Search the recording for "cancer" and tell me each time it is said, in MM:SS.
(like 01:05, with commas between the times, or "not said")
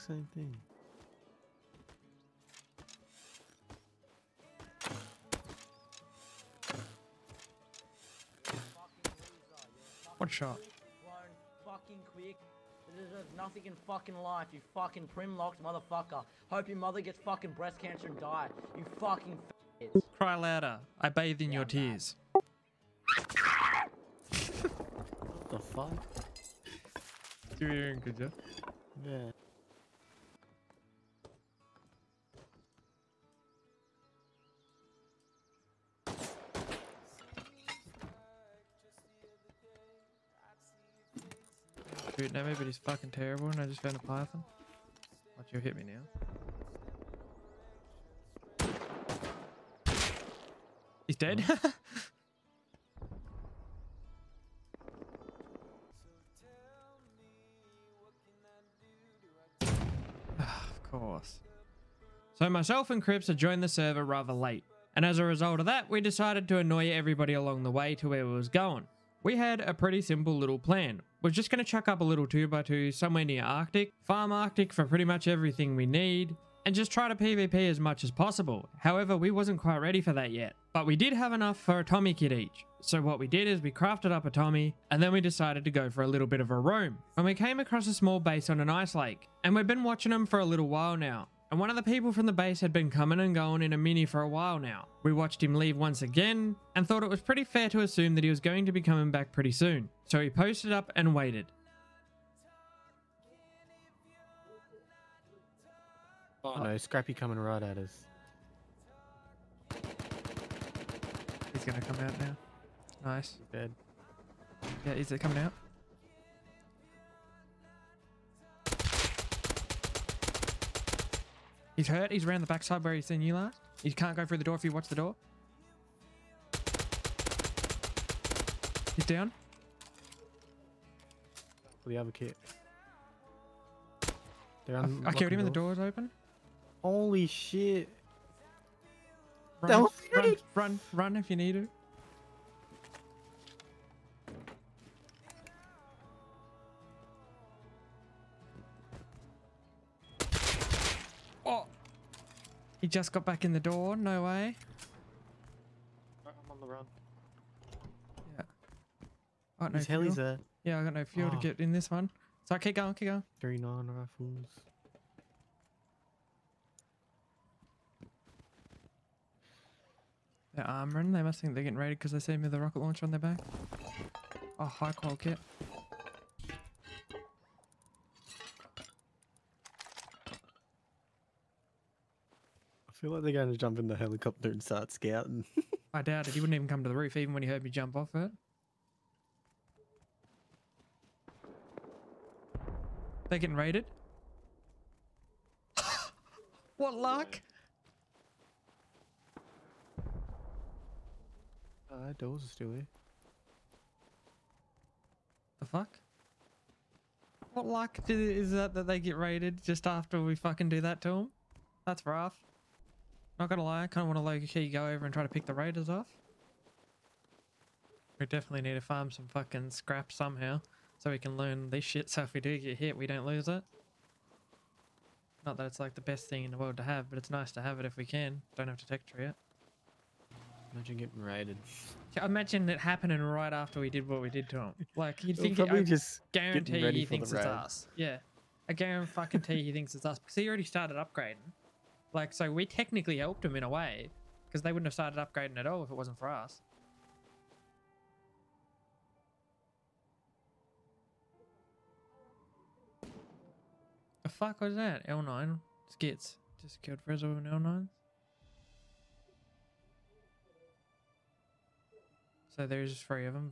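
00:17.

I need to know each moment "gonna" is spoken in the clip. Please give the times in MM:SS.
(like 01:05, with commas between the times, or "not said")
01:51, 03:33.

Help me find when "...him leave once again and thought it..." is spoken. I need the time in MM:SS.
01:35.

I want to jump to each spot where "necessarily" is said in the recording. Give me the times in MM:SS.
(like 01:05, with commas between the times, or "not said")
not said.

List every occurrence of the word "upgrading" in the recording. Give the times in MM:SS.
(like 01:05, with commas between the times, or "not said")
04:00, 04:05.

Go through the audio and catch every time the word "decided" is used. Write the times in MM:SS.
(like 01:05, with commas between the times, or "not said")
01:06, 01:25.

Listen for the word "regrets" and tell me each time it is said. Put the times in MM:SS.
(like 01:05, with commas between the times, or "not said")
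not said.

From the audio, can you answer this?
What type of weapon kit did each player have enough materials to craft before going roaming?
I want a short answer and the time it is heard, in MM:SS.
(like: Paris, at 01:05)
Tommy kit, at 01:21.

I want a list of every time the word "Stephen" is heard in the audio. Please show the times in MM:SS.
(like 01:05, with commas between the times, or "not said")
not said.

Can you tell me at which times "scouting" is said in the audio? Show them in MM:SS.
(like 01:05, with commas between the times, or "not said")
03:04.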